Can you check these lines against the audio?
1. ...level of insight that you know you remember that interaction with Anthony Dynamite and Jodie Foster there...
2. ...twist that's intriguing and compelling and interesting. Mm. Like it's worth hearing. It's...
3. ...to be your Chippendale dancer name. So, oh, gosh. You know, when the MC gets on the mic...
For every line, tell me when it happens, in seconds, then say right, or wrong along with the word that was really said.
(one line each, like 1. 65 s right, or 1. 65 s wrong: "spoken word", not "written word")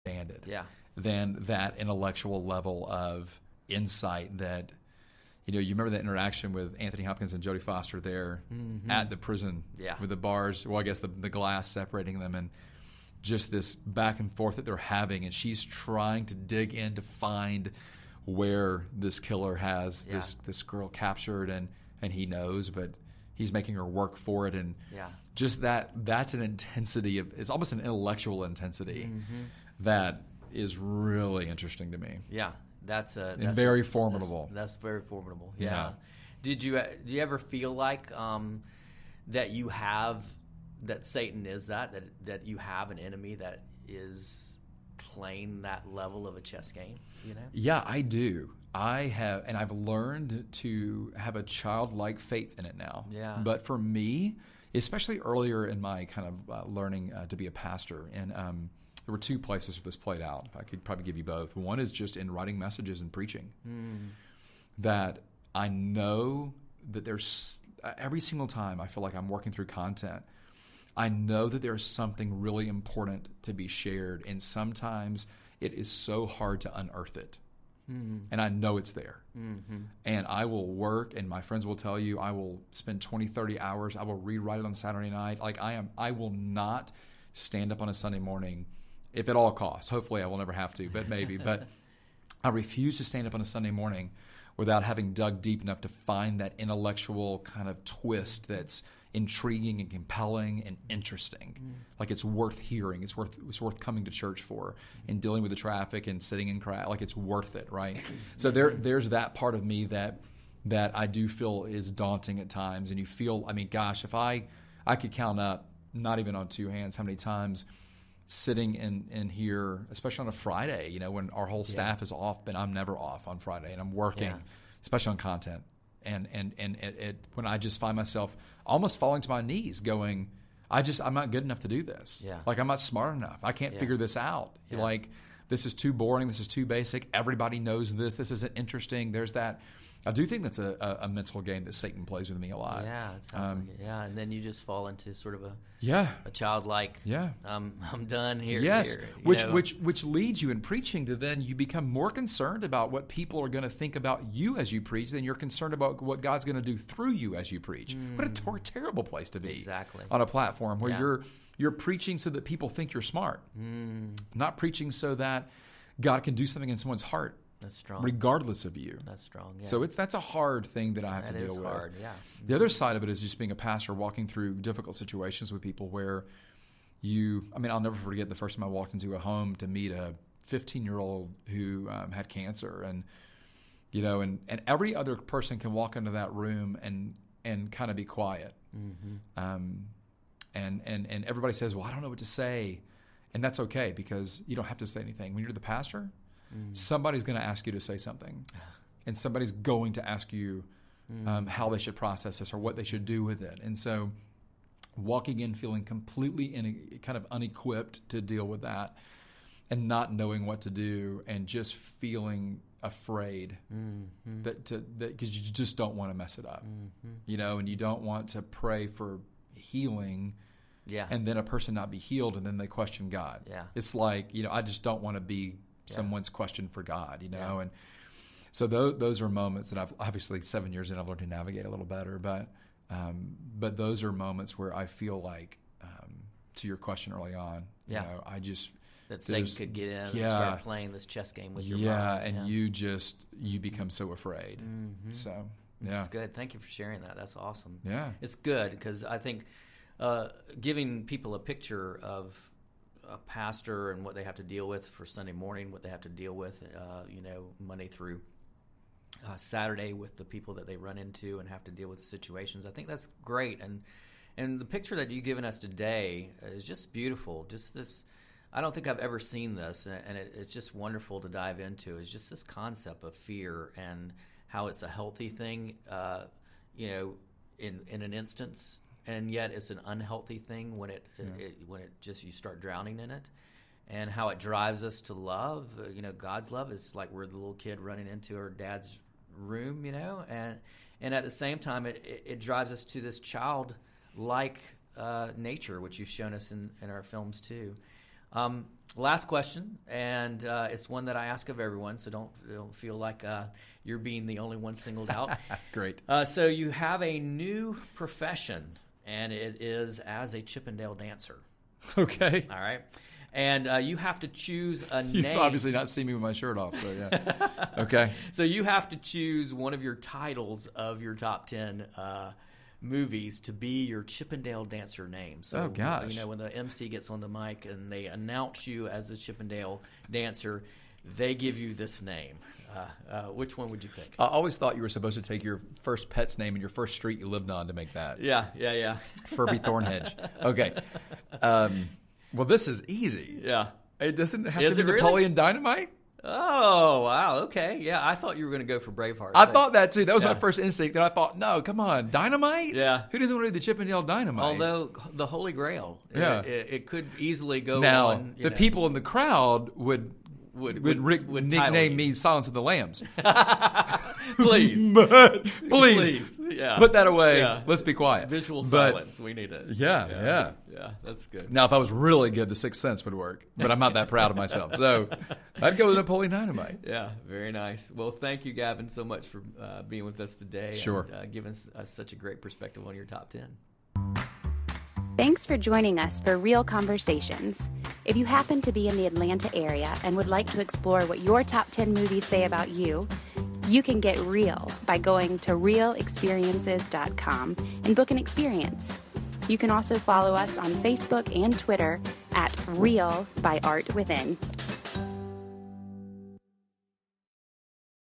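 1. 2 s wrong: "Hopkins", not "Dynamite"
2. 97 s right
3. 323 s right.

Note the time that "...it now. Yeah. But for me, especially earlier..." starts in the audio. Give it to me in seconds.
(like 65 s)
52 s.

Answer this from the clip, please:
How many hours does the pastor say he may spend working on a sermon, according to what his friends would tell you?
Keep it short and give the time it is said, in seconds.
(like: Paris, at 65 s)
20, 30 hours, at 83 s.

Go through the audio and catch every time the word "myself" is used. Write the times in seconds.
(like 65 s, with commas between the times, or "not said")
127 s, 374 s.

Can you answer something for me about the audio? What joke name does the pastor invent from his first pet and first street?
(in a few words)
Furby Thornhedge.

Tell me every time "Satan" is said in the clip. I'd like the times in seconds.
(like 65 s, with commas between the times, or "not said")
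41 s, 141 s, 239 s.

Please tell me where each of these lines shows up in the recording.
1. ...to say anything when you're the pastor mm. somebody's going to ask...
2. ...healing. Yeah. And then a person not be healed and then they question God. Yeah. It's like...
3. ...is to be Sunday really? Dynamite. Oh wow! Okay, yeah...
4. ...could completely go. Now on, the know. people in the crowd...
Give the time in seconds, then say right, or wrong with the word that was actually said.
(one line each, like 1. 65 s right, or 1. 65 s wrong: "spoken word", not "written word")
1. 194 s right
2. 219 s right
3. 344 s wrong: "Napoleon", not "Sunday"
4. 356 s wrong: "easily", not "completely".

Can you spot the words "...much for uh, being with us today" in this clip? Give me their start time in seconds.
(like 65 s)
379 s.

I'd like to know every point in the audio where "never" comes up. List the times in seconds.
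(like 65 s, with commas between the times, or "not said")
90 s, 122 s, 177 s.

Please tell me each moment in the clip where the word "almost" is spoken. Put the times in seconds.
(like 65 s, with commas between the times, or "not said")
27 s, 128 s.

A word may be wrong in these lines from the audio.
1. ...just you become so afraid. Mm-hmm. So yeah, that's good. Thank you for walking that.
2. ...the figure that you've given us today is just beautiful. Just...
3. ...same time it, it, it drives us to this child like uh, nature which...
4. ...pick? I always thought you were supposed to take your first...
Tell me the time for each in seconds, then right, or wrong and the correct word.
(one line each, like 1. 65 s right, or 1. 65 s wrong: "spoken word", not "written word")
1. 242 s wrong: "sharing", not "walking"
2. 264 s wrong: "picture", not "figure"
3. 291 s right
4. 333 s right.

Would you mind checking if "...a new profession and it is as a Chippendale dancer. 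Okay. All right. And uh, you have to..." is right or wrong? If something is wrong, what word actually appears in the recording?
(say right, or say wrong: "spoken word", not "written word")
right.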